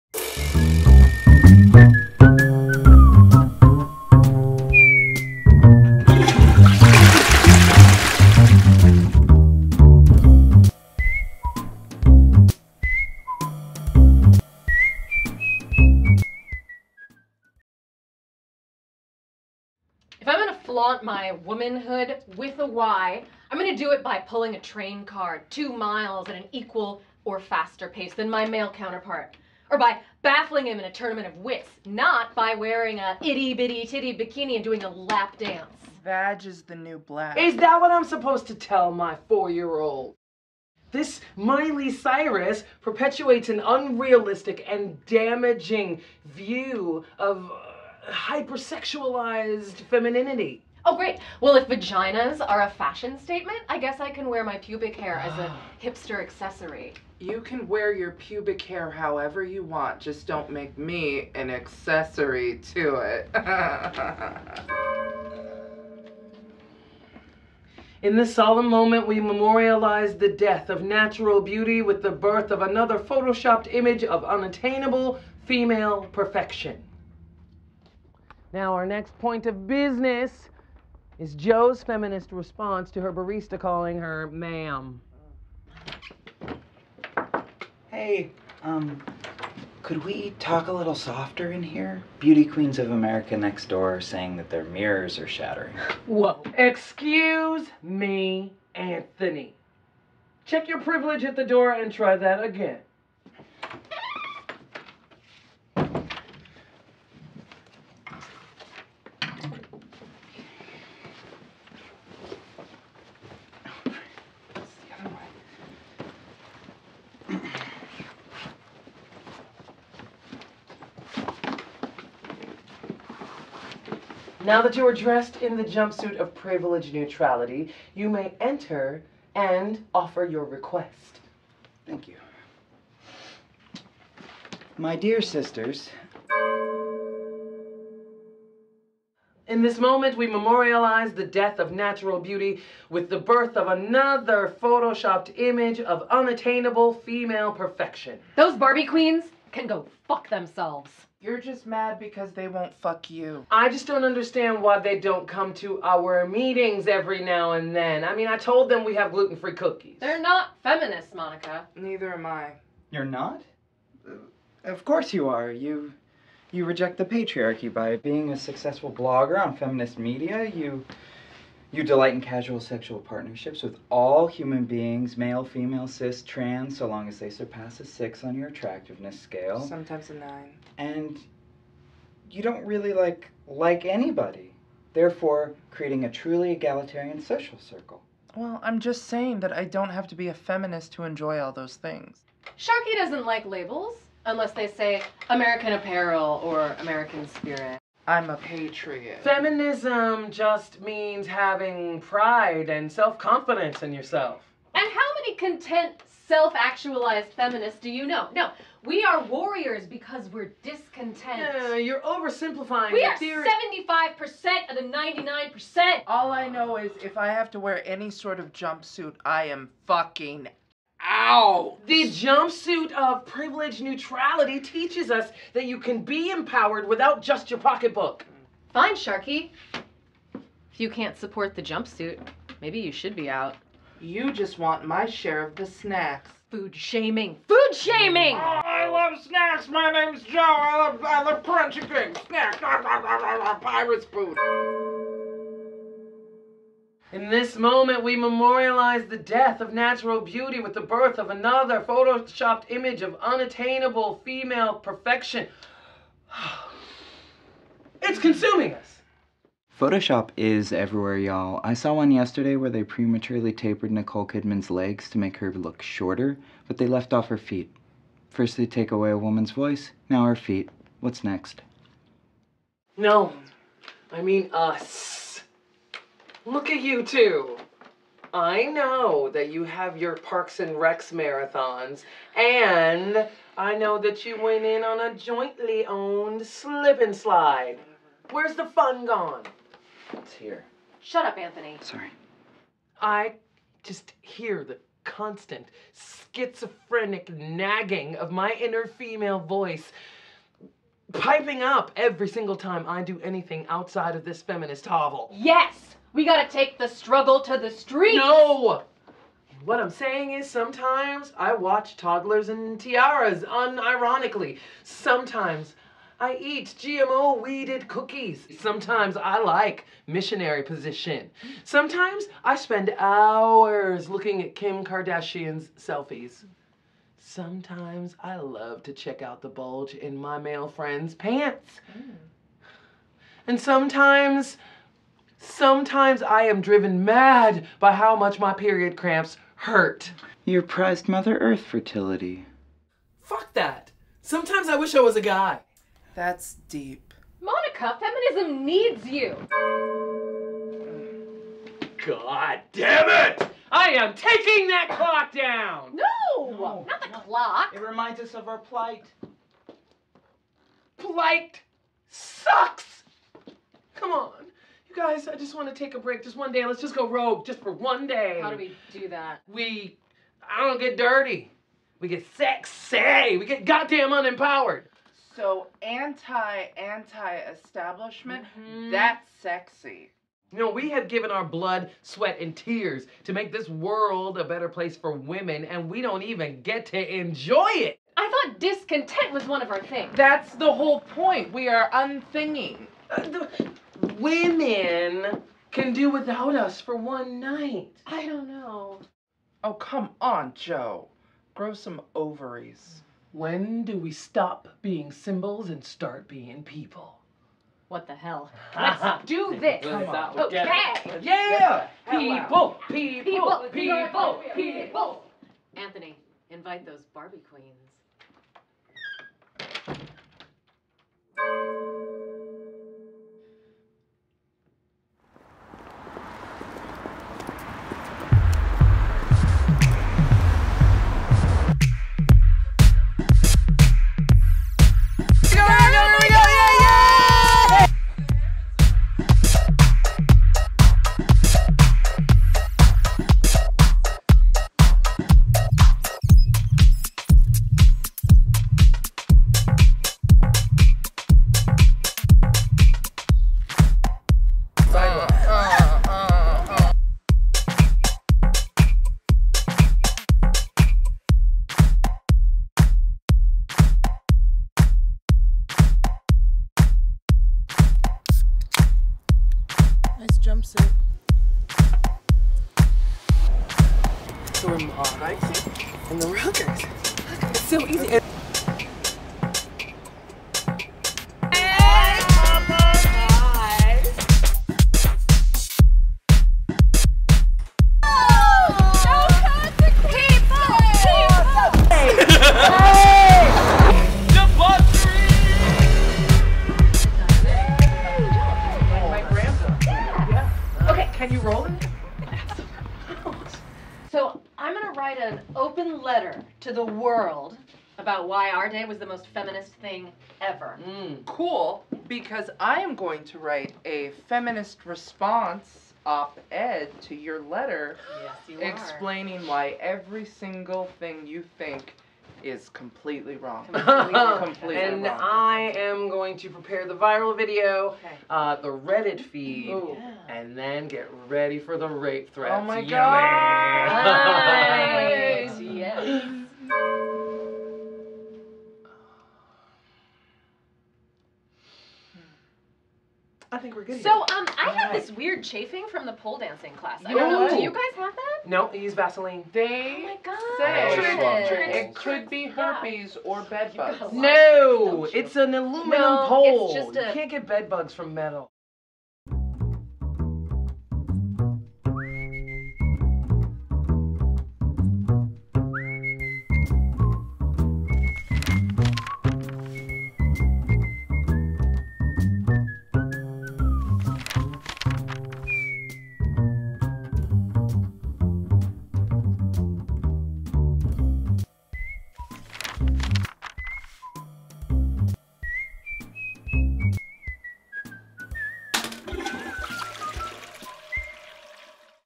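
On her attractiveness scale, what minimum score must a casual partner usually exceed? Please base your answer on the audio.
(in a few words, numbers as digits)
6.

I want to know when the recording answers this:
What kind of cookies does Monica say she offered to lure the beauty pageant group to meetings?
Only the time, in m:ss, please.
2:39.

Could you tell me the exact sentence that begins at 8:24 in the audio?
so I'm gonna write an open letter to the world about why our day was the most feminist thing ever.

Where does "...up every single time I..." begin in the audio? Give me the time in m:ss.
5:01.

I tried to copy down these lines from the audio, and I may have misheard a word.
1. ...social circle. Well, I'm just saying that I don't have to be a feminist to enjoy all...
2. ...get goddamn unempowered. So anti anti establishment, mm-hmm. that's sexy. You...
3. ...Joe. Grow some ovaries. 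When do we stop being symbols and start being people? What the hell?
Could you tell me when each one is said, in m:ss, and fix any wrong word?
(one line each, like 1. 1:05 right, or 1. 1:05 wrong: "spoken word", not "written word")
1. 3:07 right
2. 6:13 right
3. 6:40 right.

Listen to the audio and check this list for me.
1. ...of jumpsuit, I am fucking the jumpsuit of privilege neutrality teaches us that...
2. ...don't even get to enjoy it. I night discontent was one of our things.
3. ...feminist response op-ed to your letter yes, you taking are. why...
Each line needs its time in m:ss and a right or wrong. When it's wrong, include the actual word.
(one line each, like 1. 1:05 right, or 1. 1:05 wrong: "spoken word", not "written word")
1. 3:38 right
2. 6:26 wrong: "thought", not "night"
3. 8:34 wrong: "explaining", not "taking".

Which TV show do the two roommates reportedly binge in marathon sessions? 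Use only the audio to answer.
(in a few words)
Parks and Recs.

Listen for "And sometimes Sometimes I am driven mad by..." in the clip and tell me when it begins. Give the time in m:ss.
5:33.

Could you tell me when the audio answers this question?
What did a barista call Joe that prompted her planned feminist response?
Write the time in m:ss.
1:24.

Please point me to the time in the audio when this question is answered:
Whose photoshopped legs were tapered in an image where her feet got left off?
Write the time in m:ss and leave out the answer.
4:23.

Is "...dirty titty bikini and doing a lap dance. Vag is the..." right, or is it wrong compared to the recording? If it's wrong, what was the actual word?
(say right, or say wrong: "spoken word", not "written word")
wrong: "bitty", not "dirty".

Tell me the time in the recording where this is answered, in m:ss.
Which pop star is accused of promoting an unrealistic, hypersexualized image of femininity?
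0:41.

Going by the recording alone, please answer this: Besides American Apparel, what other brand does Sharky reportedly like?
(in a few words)
American Spirit.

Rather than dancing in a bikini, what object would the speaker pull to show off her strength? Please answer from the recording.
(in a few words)
A train car.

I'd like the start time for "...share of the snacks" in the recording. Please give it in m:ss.
3:55.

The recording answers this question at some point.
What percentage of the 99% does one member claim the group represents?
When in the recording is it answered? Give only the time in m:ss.
3:33.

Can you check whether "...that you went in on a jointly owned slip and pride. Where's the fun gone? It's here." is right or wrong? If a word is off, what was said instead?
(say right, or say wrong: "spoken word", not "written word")
wrong: "slide", not "pride".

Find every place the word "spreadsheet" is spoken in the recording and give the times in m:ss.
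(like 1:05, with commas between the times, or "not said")
not said.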